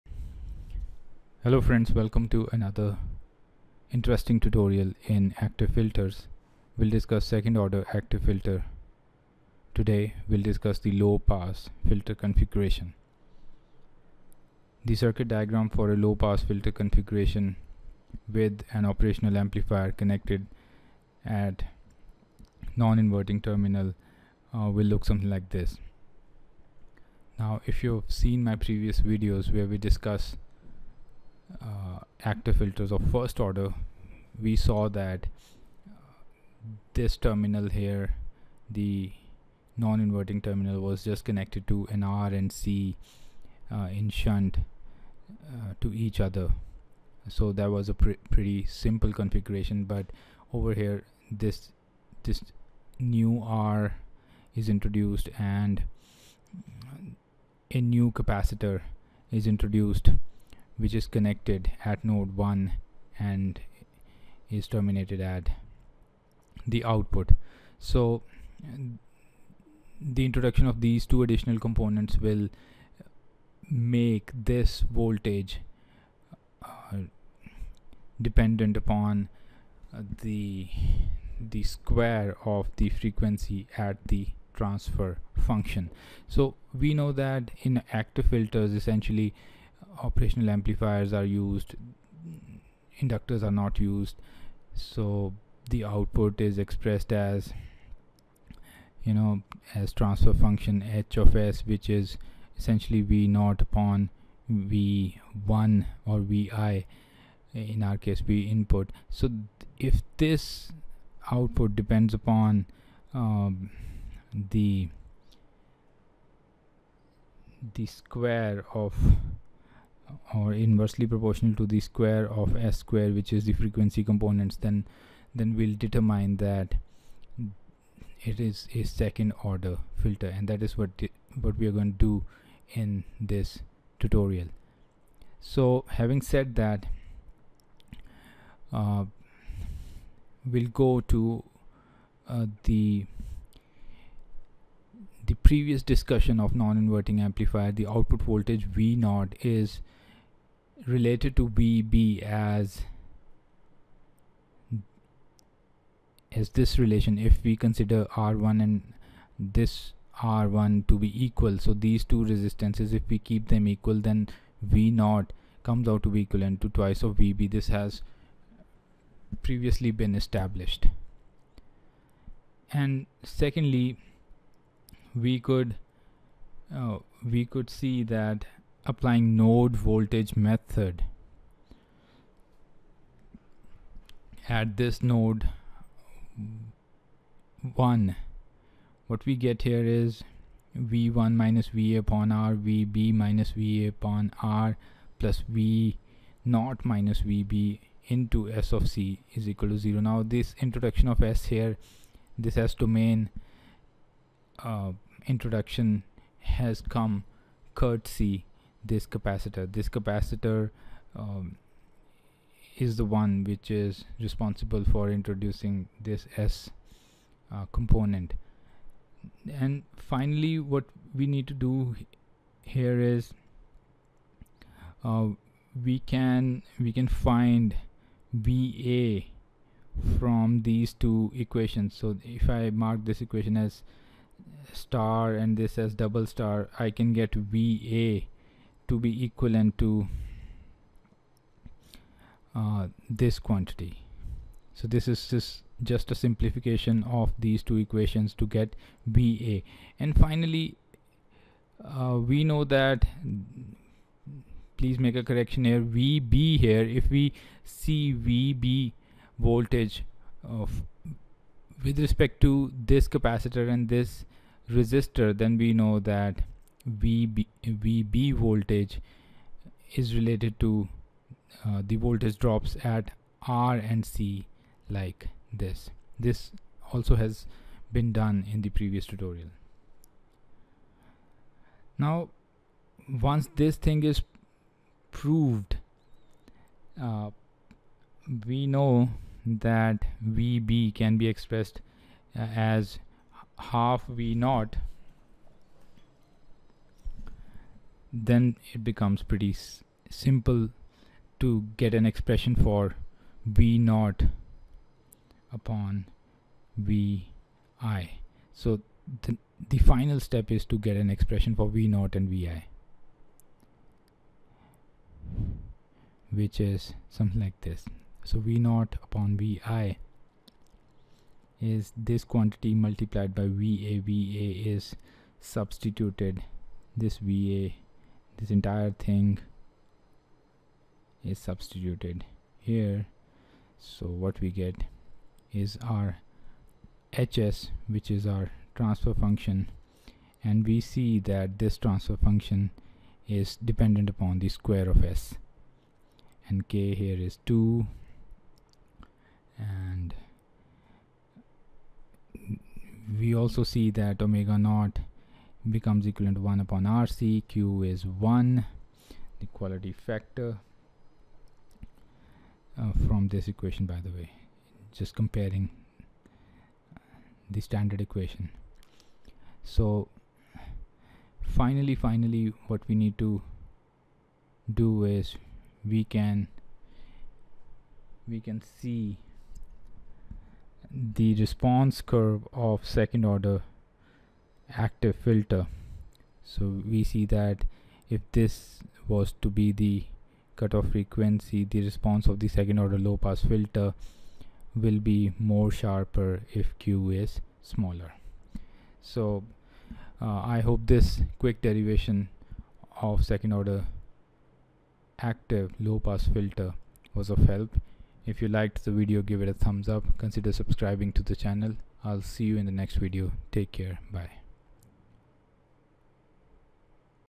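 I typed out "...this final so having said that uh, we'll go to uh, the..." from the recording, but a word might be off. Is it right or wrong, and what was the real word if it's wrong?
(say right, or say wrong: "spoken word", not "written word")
wrong: "tutorial", not "final".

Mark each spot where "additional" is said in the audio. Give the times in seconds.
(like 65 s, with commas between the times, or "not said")
71 s.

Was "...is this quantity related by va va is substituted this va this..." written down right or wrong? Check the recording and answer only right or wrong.
wrong.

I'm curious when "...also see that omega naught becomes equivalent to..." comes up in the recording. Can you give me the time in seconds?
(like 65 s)
353 s.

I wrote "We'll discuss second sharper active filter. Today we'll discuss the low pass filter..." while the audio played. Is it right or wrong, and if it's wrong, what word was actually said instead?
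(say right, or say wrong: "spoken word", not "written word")
wrong: "order", not "sharper".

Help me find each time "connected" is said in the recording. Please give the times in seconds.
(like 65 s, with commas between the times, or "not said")
19 s, 41 s, 61 s.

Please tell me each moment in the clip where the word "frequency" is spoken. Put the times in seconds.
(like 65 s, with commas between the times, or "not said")
83 s, 123 s, 390 s.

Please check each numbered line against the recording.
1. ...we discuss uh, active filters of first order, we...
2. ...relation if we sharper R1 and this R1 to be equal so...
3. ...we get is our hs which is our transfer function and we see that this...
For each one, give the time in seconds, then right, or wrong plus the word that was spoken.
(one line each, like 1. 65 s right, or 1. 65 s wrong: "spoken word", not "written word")
1. 29 s right
2. 156 s wrong: "consider", not "sharper"
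3. 334 s right.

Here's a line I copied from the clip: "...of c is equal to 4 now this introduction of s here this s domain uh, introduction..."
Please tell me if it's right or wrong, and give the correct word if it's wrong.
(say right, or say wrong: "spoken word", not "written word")
wrong: "0", not "4".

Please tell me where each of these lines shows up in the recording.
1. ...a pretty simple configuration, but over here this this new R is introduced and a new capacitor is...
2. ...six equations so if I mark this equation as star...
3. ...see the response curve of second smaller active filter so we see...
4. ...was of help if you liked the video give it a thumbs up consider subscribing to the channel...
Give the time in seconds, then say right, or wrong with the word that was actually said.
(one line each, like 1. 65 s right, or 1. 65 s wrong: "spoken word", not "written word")
1. 47 s right
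2. 230 s wrong: "two", not "six"
3. 378 s wrong: "order", not "smaller"
4. 407 s right.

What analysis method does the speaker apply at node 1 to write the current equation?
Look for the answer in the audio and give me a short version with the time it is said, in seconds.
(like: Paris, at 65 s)
Node voltage method, at 179 s.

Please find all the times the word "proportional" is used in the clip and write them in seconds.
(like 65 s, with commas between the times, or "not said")
121 s.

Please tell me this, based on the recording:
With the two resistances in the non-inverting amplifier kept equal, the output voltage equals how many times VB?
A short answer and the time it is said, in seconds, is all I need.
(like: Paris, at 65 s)
Twice, at 166 s.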